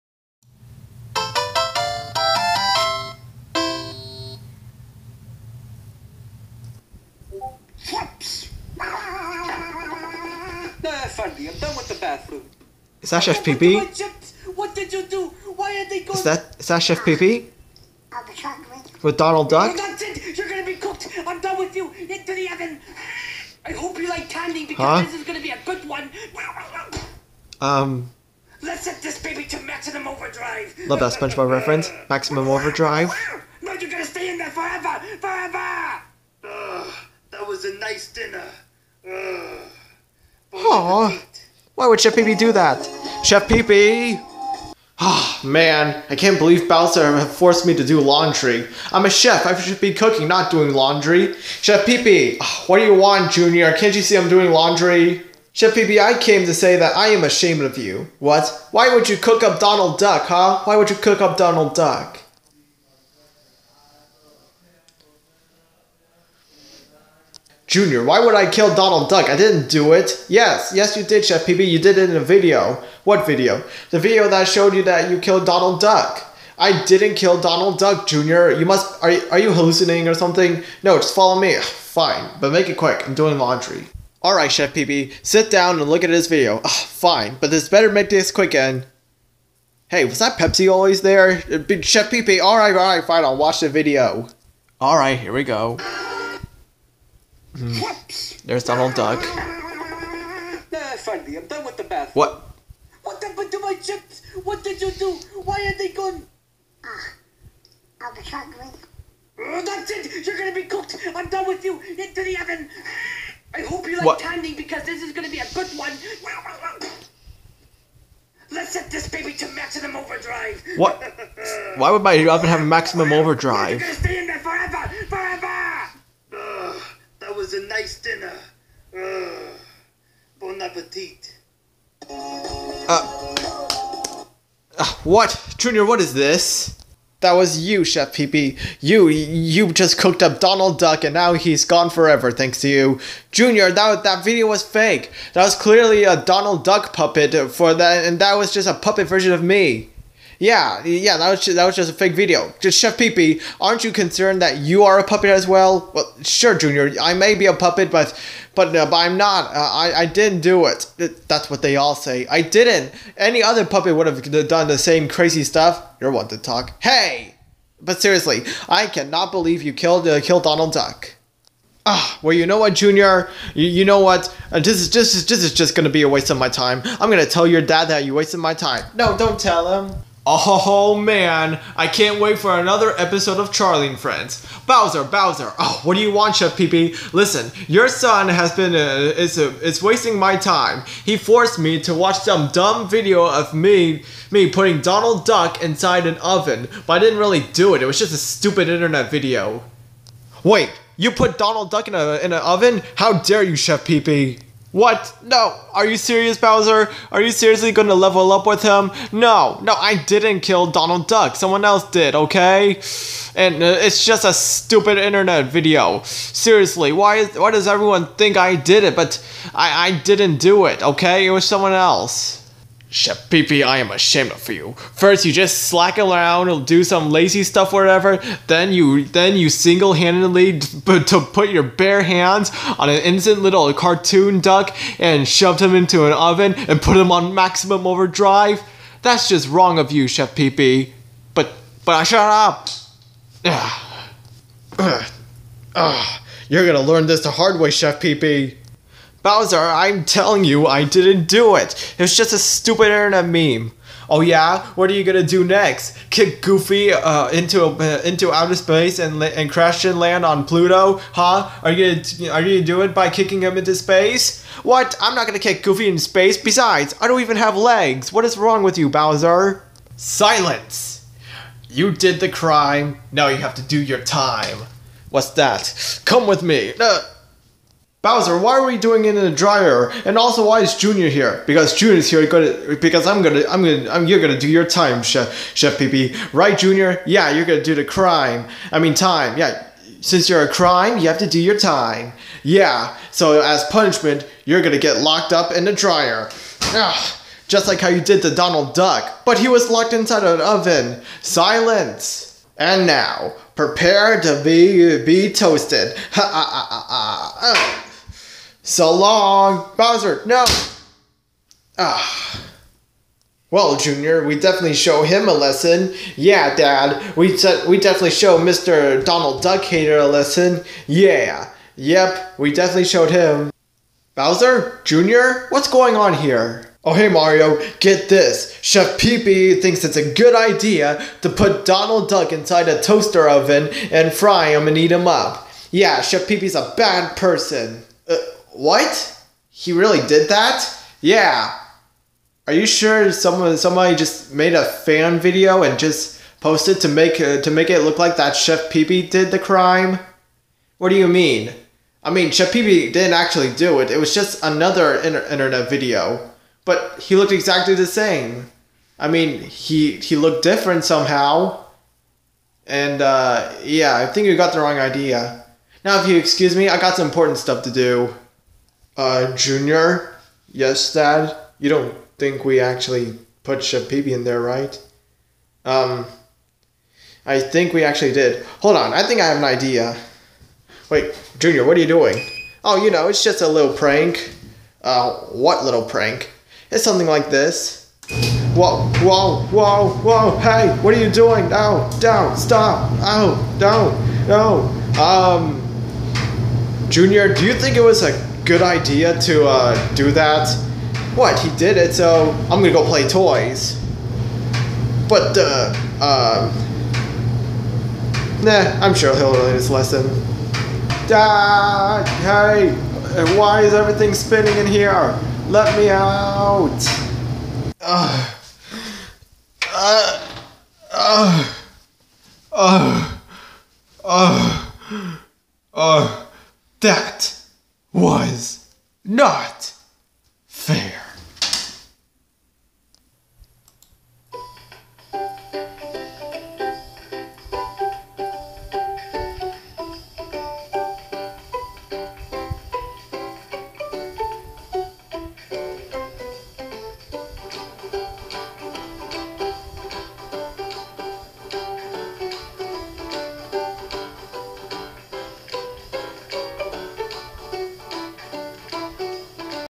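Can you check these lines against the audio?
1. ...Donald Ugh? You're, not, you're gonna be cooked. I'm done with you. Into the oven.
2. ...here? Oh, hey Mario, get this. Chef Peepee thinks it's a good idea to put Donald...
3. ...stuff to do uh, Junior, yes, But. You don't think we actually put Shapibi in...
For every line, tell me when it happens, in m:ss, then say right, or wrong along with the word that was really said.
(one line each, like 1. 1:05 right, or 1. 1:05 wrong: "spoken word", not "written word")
1. 0:19 wrong: "Duck", not "Ugh"
2. 5:26 right
3. 6:07 wrong: "Dad", not "But".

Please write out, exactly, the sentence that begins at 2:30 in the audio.
Yeah, yeah, that was just, that was just a fake video.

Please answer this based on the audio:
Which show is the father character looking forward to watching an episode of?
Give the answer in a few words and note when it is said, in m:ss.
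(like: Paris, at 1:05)
Charlie and Friends, at 3:03.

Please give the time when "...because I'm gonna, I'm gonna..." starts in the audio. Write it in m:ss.
4:42.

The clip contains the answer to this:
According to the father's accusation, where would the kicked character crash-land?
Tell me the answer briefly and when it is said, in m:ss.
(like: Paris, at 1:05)
Pluto, at 4:20.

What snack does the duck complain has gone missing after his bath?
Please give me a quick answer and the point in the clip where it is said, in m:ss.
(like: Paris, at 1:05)
Chips, at 1:43.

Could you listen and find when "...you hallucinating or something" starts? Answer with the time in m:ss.
1:19.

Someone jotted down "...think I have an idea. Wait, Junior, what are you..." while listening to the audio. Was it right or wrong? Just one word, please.
right.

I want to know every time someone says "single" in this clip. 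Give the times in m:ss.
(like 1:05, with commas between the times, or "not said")
3:49.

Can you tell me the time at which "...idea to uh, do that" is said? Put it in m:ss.
6:38.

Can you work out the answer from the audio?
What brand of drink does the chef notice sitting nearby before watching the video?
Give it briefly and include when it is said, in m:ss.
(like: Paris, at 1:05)
Pepsi, at 1:30.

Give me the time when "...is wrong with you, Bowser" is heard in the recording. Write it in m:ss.
4:28.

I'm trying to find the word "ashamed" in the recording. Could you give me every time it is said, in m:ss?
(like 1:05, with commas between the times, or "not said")
0:57, 3:43.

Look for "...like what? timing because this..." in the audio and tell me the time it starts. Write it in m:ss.
1:53.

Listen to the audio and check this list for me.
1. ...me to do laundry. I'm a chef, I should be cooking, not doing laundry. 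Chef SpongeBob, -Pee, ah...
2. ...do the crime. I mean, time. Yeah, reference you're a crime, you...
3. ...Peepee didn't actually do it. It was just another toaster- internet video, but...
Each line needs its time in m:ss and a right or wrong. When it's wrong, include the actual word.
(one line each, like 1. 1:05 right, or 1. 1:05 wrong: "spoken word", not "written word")
1. 0:47 wrong: "Peepee", not "SpongeBob"
2. 4:47 wrong: "since", not "reference"
3. 5:52 wrong: "inter", not "toaster".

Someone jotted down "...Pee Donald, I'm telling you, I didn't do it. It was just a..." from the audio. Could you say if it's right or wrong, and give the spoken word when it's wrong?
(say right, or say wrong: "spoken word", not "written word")
wrong: "Bowser", not "Donald".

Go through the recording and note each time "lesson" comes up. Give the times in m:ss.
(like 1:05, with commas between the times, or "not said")
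5:15, 5:20, 6:49.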